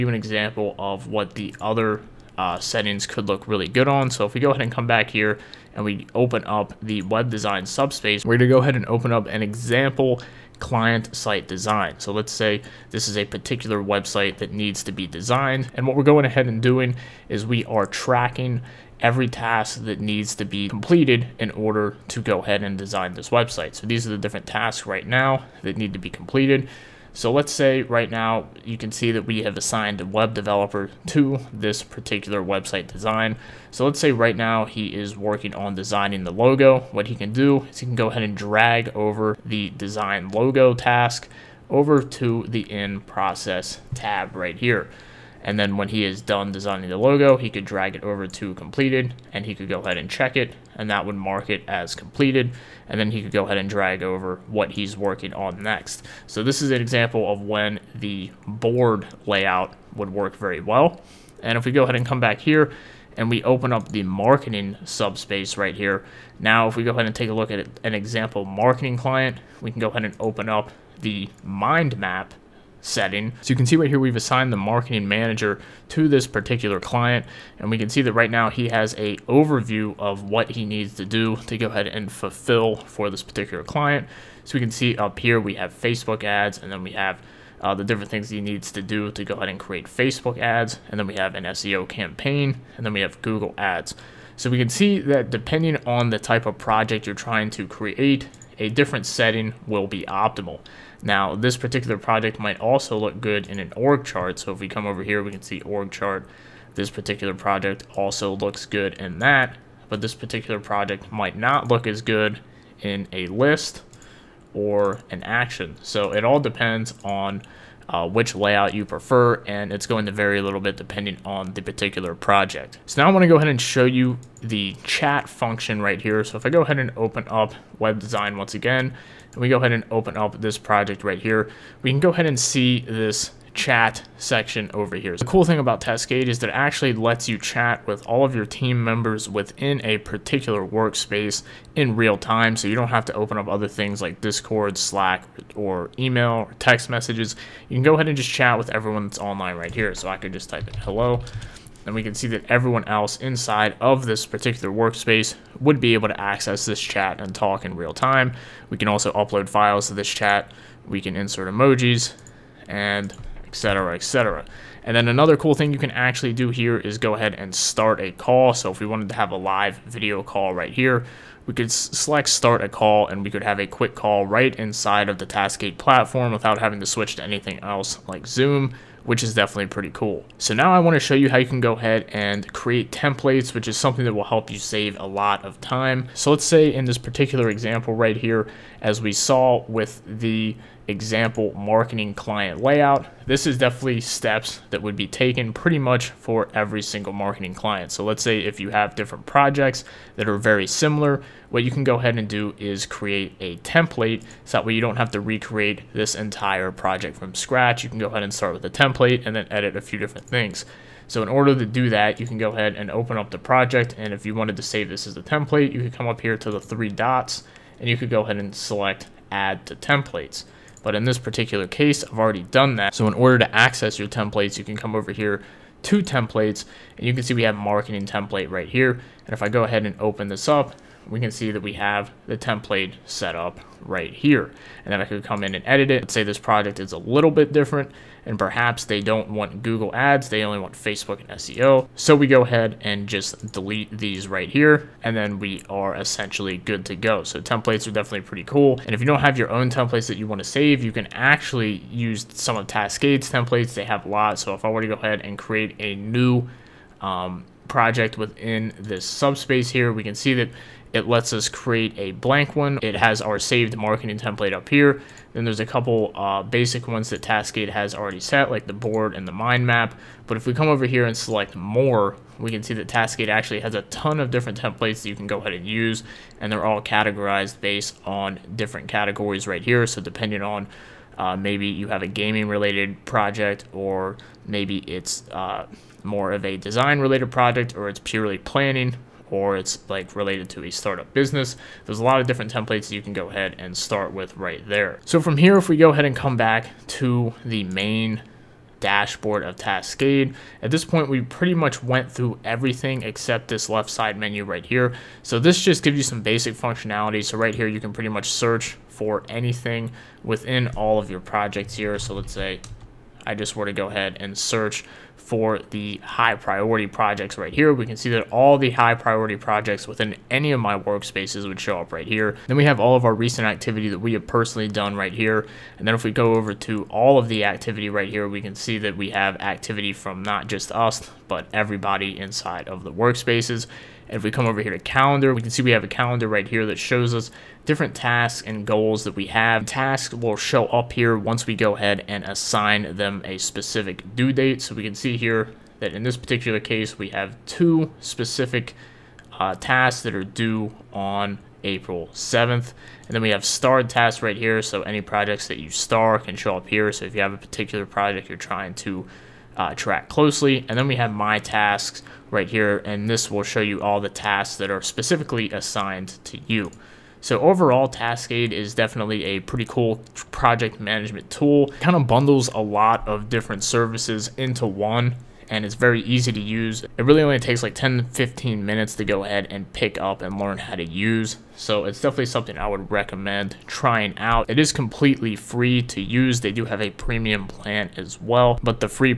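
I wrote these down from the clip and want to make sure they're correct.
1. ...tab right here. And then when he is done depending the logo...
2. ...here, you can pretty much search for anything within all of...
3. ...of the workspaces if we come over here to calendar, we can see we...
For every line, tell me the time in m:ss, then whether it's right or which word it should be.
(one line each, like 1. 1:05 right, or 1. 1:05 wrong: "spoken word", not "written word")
1. 0:43 wrong: "designing", not "depending"
2. 5:07 right
3. 5:32 right.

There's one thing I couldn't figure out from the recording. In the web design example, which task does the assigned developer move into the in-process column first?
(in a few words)
Design logo.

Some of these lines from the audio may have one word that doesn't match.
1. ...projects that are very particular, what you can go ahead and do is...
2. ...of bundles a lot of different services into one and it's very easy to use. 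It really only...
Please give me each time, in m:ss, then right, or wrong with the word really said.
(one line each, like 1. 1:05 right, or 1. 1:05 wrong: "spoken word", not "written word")
1. 3:19 wrong: "similar", not "particular"
2. 6:11 right.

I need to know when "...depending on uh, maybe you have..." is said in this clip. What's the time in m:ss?
4:40.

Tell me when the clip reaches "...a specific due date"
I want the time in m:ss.
5:43.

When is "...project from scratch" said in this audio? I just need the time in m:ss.
3:26.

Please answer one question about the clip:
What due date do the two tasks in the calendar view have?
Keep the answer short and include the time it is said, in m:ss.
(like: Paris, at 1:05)
April 7th, at 5:51.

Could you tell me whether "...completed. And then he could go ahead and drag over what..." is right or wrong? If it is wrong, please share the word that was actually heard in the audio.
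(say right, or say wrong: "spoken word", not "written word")
right.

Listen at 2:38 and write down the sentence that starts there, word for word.
We can also upload files to this chat.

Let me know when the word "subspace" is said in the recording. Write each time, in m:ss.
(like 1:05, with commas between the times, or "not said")
0:07, 1:04, 4:19.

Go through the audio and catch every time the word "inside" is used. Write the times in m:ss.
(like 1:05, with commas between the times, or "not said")
2:33, 2:54, 5:32.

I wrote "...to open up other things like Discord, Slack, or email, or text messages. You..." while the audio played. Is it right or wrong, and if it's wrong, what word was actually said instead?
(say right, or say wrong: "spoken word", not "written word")
right.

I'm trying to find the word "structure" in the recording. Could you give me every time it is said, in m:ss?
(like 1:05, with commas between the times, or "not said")
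not said.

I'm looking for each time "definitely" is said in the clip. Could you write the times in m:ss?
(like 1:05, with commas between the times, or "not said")
2:59, 3:13, 4:07, 6:08, 6:22.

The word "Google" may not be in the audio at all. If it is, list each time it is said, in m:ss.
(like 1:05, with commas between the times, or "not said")
1:33, 3:59.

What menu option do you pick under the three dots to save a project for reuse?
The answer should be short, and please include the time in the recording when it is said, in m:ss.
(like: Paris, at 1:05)
Add to templates, at 3:39.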